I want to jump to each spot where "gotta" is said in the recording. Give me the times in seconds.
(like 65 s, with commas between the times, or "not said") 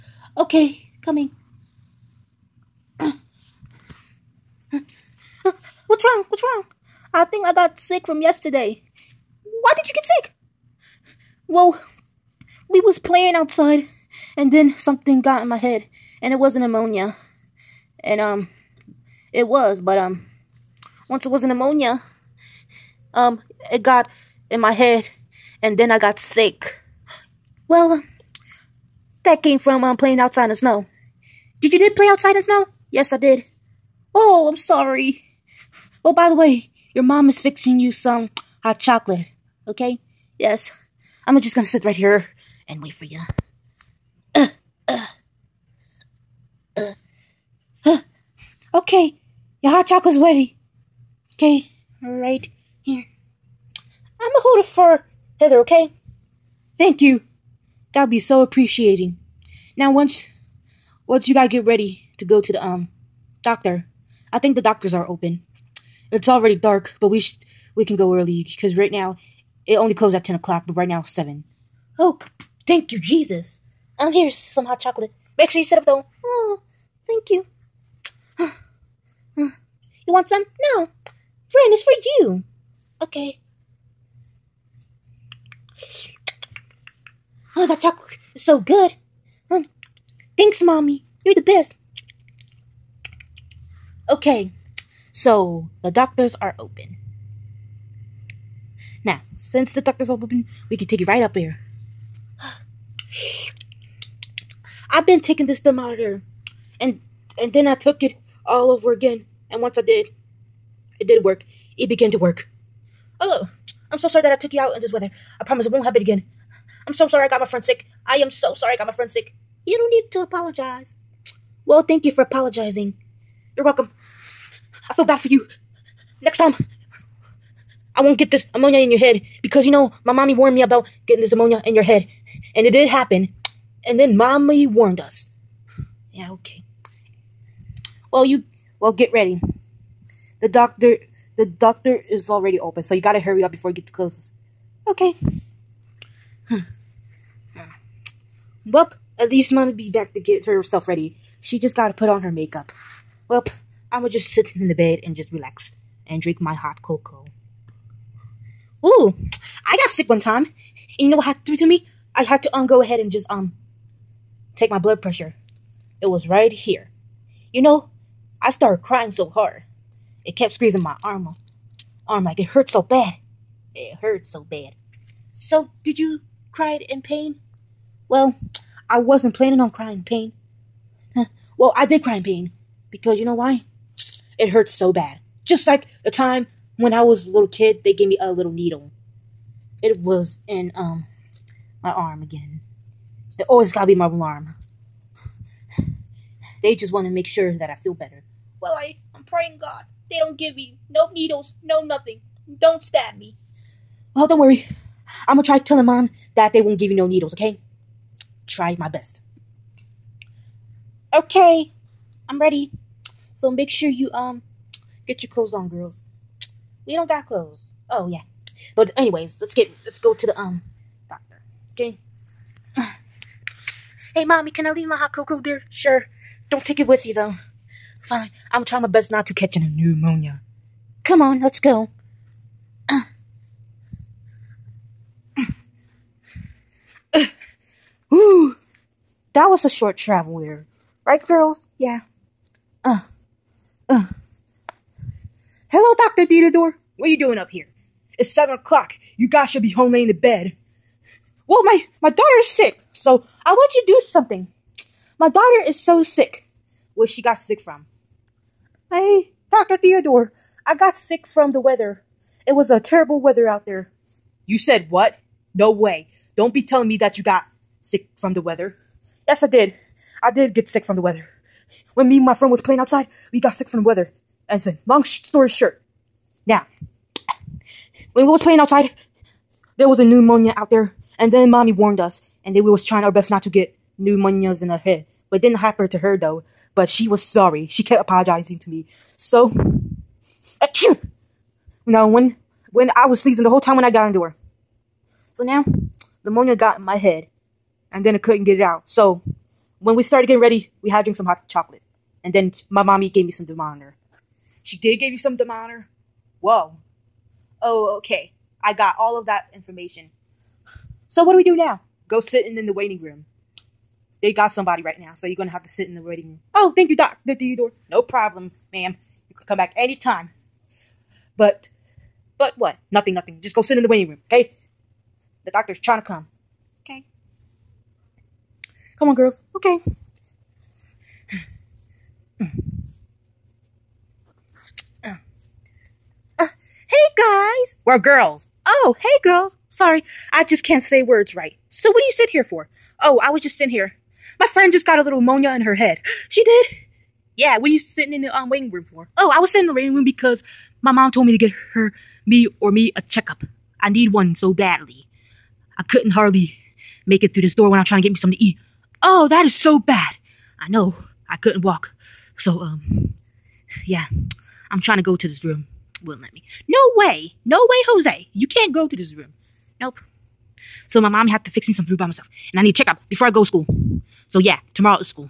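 61 s, 143 s, 151 s, 193 s.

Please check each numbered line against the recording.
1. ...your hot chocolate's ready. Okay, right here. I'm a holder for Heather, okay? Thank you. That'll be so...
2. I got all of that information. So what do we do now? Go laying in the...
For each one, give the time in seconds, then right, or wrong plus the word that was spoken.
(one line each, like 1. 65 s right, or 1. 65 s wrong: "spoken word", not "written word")
1. 49 s right
2. 308 s wrong: "sitting", not "laying".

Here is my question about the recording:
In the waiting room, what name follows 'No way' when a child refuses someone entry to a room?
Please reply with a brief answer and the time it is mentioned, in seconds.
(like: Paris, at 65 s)
Jose, at 367 s.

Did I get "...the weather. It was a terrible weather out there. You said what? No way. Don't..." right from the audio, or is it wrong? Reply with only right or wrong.
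right.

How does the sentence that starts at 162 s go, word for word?
I had to um go ahead and just um take my blood pressure.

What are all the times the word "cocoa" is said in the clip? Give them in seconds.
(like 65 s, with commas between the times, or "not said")
156 s, 225 s.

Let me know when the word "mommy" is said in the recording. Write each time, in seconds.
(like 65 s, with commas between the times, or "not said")
90 s, 130 s, 134 s, 224 s, 281 s, 302 s, 371 s.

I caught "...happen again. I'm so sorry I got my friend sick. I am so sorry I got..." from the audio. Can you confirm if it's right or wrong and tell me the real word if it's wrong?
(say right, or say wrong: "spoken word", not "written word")
right.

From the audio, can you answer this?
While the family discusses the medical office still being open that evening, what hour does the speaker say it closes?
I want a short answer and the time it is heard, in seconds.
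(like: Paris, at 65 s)
10 o'clock, at 70 s.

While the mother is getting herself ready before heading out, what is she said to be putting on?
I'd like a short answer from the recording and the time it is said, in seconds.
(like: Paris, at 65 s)
makeup, at 152 s.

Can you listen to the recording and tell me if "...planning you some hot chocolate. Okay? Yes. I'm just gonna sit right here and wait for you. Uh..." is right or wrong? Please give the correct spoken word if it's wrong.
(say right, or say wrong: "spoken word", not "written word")
wrong: "fixing", not "planning".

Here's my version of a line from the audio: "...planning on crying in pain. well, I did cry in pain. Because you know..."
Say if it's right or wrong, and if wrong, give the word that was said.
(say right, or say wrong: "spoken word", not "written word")
right.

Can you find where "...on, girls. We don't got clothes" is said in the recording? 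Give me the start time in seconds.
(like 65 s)
215 s.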